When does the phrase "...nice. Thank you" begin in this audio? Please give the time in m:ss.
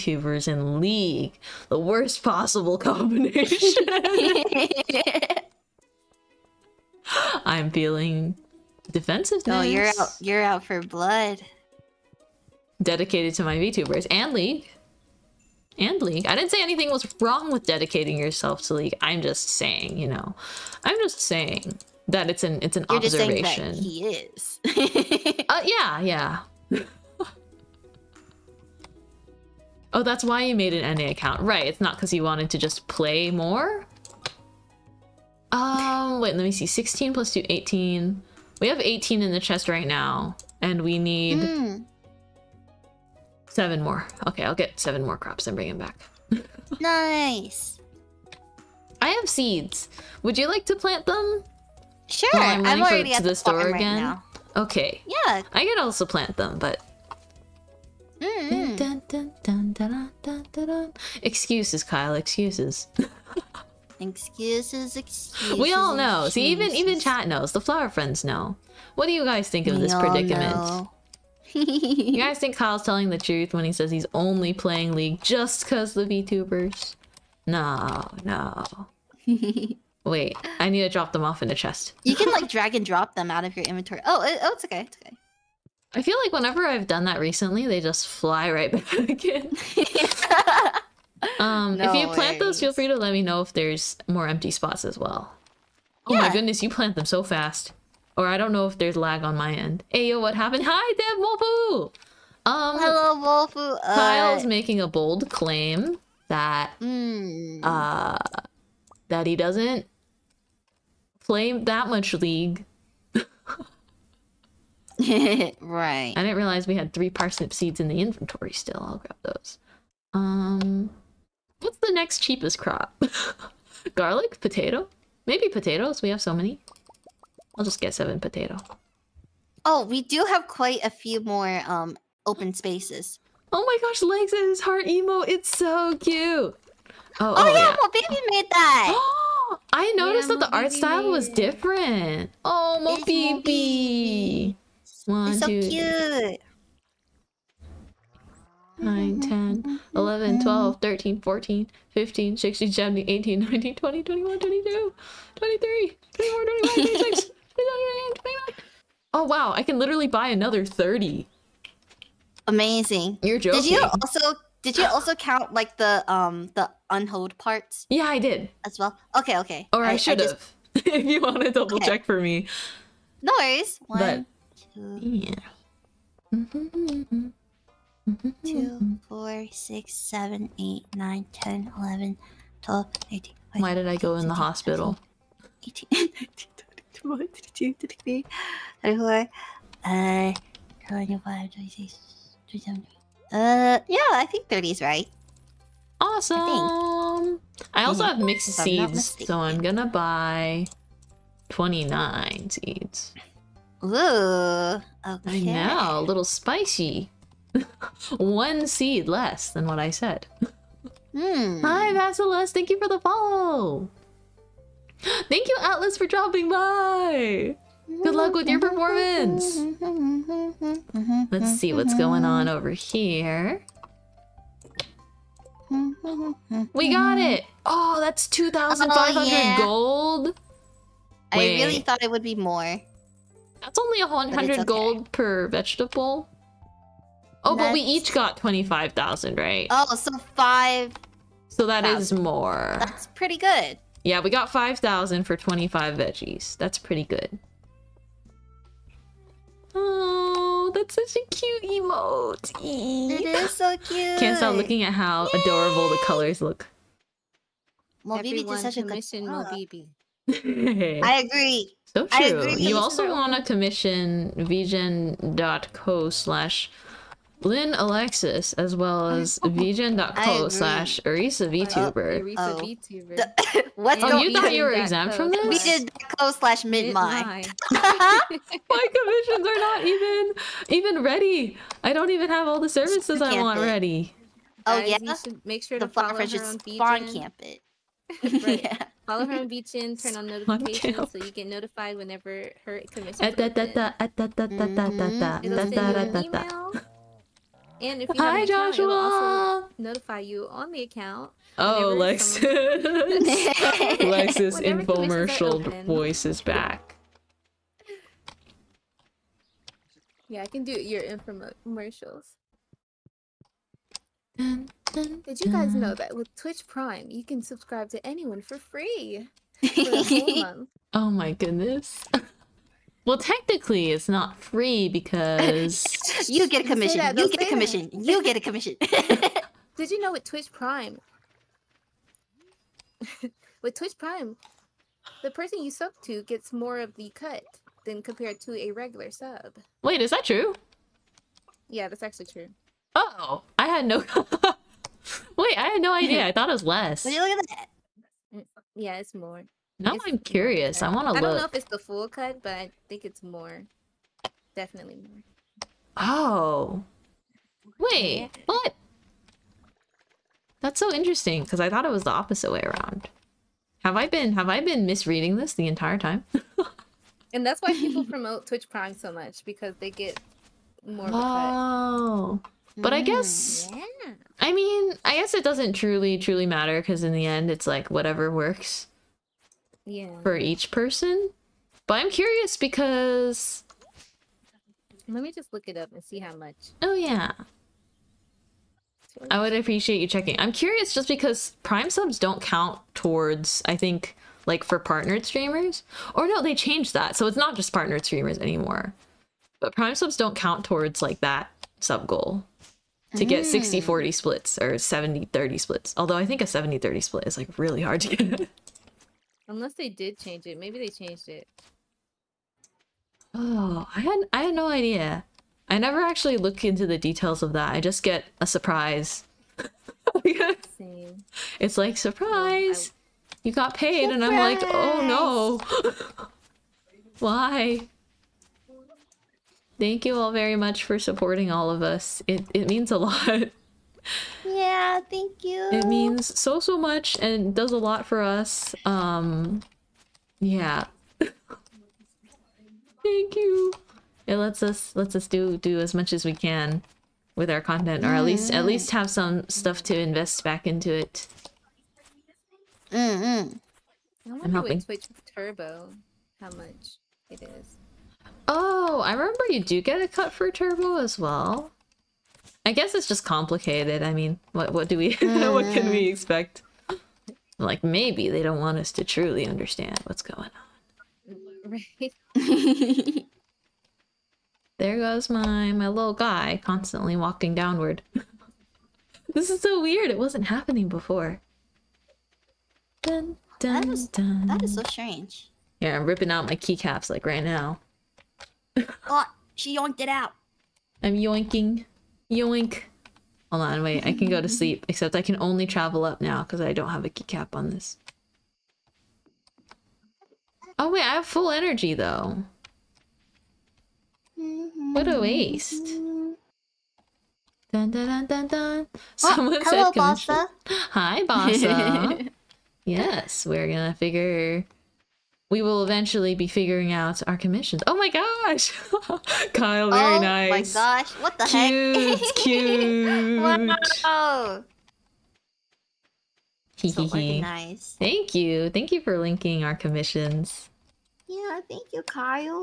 8:47.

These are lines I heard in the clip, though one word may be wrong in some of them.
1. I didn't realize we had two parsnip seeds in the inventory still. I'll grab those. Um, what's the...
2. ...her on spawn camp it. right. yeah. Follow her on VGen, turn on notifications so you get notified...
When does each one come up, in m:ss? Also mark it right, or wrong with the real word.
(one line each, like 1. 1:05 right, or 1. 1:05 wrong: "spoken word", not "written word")
1. 1:56 wrong: "three", not "two"
2. 4:46 right.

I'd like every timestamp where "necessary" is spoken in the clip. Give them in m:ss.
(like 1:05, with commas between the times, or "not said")
not said.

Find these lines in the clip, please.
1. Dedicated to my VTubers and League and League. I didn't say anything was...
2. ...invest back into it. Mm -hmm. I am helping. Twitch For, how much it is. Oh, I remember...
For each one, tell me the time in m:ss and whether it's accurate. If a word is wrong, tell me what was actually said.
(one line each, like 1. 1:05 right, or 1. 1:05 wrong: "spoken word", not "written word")
1. 0:12 right
2. 7:29 wrong: "Turbo", not "For".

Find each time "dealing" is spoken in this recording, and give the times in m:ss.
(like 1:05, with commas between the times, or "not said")
not said.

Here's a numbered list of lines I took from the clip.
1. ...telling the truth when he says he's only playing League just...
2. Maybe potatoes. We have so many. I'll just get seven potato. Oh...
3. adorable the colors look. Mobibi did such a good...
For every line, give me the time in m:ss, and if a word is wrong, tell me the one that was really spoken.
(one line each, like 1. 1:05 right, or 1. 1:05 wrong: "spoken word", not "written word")
1. 1:12 right
2. 2:05 right
3. 4:15 right.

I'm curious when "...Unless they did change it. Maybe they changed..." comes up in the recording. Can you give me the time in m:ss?
6:49.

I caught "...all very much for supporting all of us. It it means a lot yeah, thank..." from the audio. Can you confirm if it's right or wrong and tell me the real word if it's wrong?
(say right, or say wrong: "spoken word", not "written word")
right.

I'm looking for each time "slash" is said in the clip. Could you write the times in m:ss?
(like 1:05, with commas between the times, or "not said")
4:26, 4:30, 4:36.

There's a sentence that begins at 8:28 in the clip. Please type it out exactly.
Oh, Someone oh, hello, said Bossa.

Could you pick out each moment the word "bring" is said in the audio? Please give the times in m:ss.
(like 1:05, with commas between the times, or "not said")
0:45.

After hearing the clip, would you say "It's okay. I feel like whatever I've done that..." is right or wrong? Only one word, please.
wrong.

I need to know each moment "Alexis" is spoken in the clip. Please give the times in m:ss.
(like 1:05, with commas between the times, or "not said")
4:27, 5:01.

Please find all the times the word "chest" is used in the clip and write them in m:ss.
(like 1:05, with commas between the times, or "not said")
0:39, 1:21.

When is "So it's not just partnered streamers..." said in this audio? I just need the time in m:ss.
6:37.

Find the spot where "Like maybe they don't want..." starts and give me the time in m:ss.
7:47.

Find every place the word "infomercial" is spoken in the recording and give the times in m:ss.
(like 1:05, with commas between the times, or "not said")
5:04, 5:11.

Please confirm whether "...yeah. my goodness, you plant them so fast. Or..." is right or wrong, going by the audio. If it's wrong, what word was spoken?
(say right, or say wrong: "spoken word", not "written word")
right.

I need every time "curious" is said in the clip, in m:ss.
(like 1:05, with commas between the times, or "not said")
5:50, 6:22, 6:30.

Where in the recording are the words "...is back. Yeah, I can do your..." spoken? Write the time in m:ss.
5:06.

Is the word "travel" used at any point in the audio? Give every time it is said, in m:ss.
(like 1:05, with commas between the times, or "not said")
8:15.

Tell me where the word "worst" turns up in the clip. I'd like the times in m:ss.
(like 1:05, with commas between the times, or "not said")
0:01.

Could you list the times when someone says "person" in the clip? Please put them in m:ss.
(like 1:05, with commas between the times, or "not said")
5:35, 6:20.